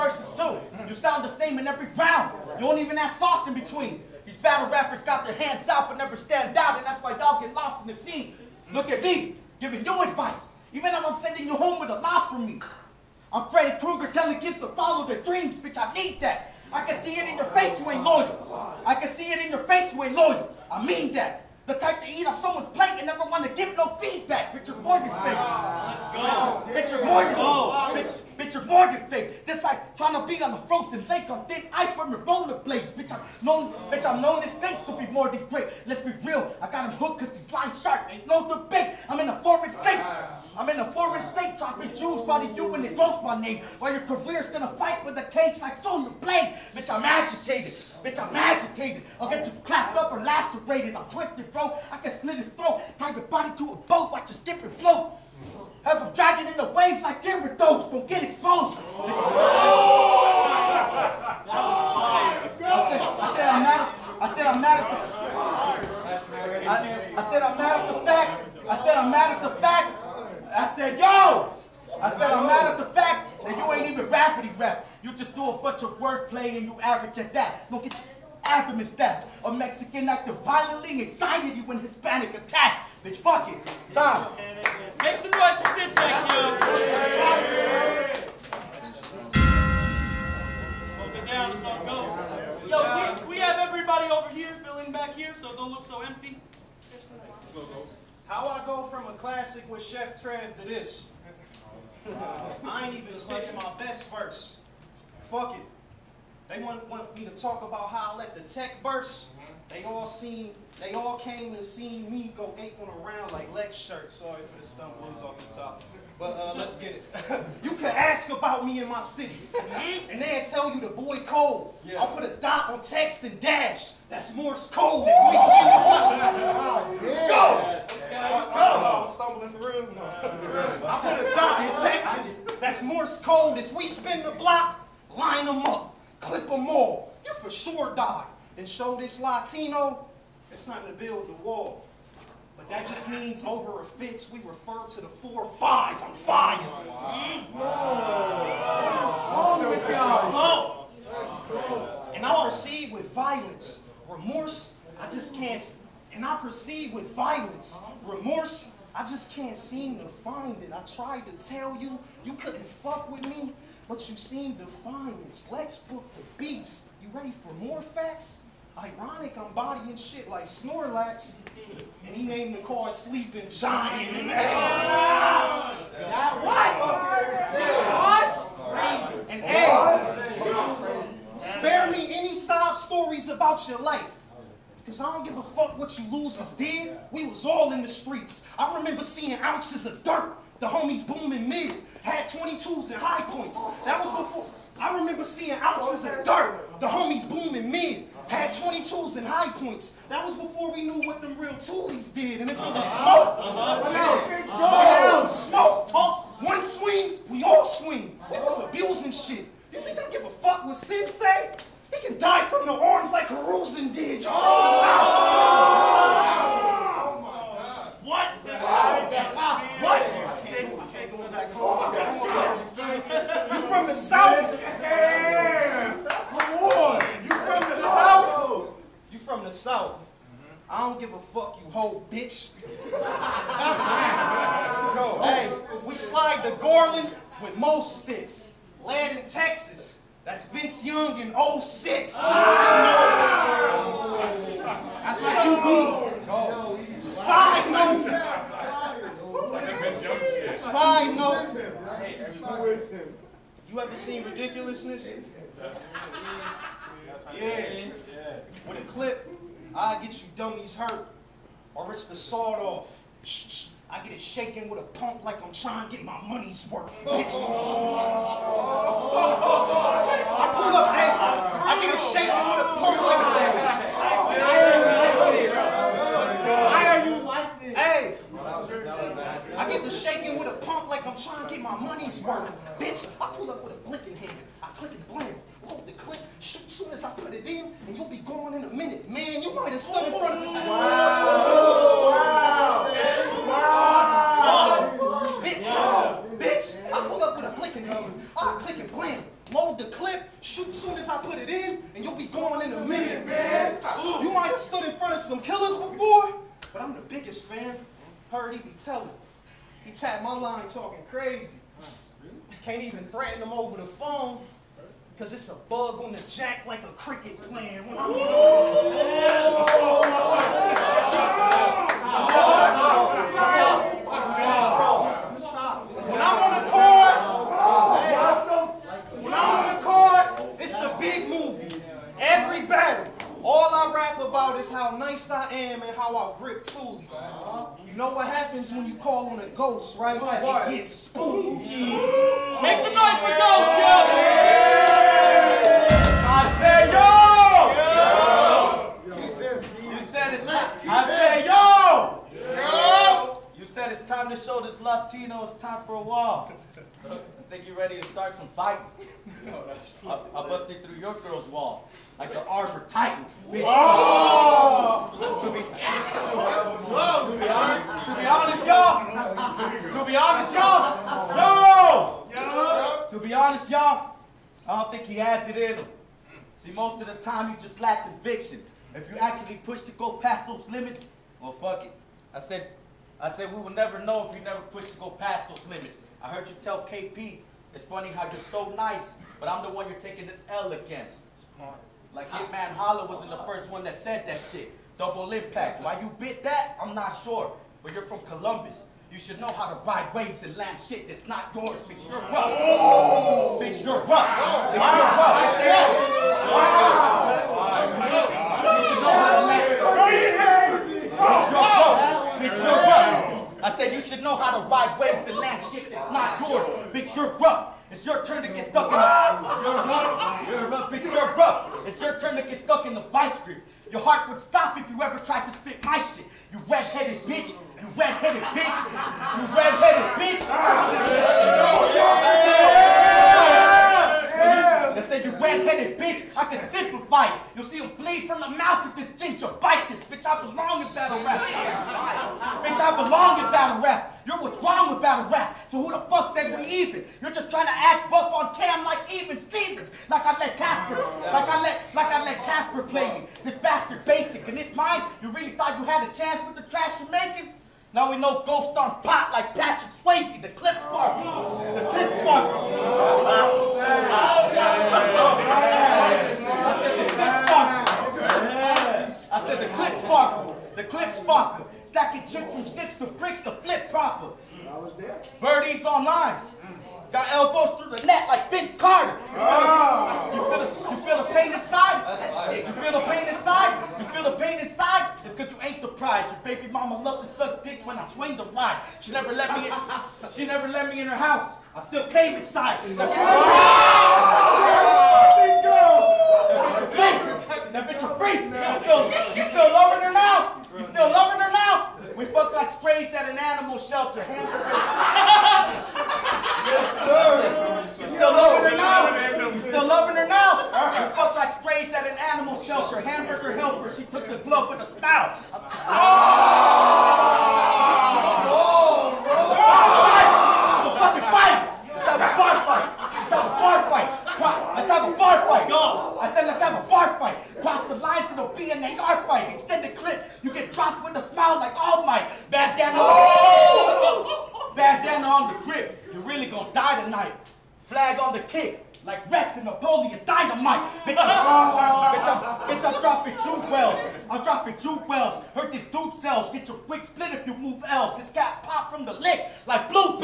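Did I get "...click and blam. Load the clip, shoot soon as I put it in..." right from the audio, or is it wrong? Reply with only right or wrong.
right.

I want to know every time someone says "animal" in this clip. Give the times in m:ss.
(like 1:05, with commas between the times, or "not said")
8:23, 8:32.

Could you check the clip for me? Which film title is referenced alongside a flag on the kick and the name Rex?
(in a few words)
Napoleon Dynamite.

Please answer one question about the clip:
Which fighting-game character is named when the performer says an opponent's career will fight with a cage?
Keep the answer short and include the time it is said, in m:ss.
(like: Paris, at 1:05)
Sonya Blade, at 0:45.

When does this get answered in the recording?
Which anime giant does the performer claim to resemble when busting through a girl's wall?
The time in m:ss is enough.
6:02.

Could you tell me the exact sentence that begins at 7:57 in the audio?
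Got elbows through the net like Vince Carter.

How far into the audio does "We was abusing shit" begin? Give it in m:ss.
3:28.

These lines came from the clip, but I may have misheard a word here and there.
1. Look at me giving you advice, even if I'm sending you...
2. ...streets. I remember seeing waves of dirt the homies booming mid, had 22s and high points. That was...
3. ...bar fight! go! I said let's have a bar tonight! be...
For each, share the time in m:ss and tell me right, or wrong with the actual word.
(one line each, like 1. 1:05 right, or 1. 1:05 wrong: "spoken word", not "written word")
1. 0:08 right
2. 3:07 wrong: "ounces", not "waves"
3. 8:45 wrong: "fight", not "tonight".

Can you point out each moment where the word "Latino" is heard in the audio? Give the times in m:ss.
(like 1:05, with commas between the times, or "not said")
2:19, 5:54.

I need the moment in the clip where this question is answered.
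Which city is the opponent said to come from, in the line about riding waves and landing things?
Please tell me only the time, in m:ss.
6:38.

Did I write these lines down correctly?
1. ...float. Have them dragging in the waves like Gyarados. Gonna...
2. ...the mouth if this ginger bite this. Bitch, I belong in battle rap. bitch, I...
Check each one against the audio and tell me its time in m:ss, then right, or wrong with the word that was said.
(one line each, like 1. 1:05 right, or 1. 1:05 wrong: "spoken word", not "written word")
1. 0:54 right
2. 7:18 right.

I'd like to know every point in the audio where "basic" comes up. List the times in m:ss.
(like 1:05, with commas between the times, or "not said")
7:34.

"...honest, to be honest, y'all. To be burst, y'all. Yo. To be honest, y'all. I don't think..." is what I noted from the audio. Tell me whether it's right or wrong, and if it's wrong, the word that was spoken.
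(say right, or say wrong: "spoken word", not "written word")
wrong: "honest", not "burst".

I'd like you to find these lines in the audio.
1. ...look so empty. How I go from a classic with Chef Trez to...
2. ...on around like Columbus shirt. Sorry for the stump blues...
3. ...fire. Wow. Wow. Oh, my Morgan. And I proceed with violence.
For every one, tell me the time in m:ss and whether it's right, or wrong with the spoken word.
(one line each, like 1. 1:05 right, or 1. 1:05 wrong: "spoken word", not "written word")
1. 1:35 right
2. 1:52 wrong: "Lex", not "Columbus"
3. 2:26 wrong: "God", not "Morgan".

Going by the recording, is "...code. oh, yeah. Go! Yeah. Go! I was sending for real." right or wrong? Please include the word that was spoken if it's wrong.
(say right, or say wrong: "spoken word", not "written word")
wrong: "stumbling", not "sending".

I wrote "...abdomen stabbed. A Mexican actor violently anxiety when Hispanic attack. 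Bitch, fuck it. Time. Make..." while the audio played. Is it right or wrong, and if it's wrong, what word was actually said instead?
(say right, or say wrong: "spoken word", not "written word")
right.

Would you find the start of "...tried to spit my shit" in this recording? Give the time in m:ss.
7:05.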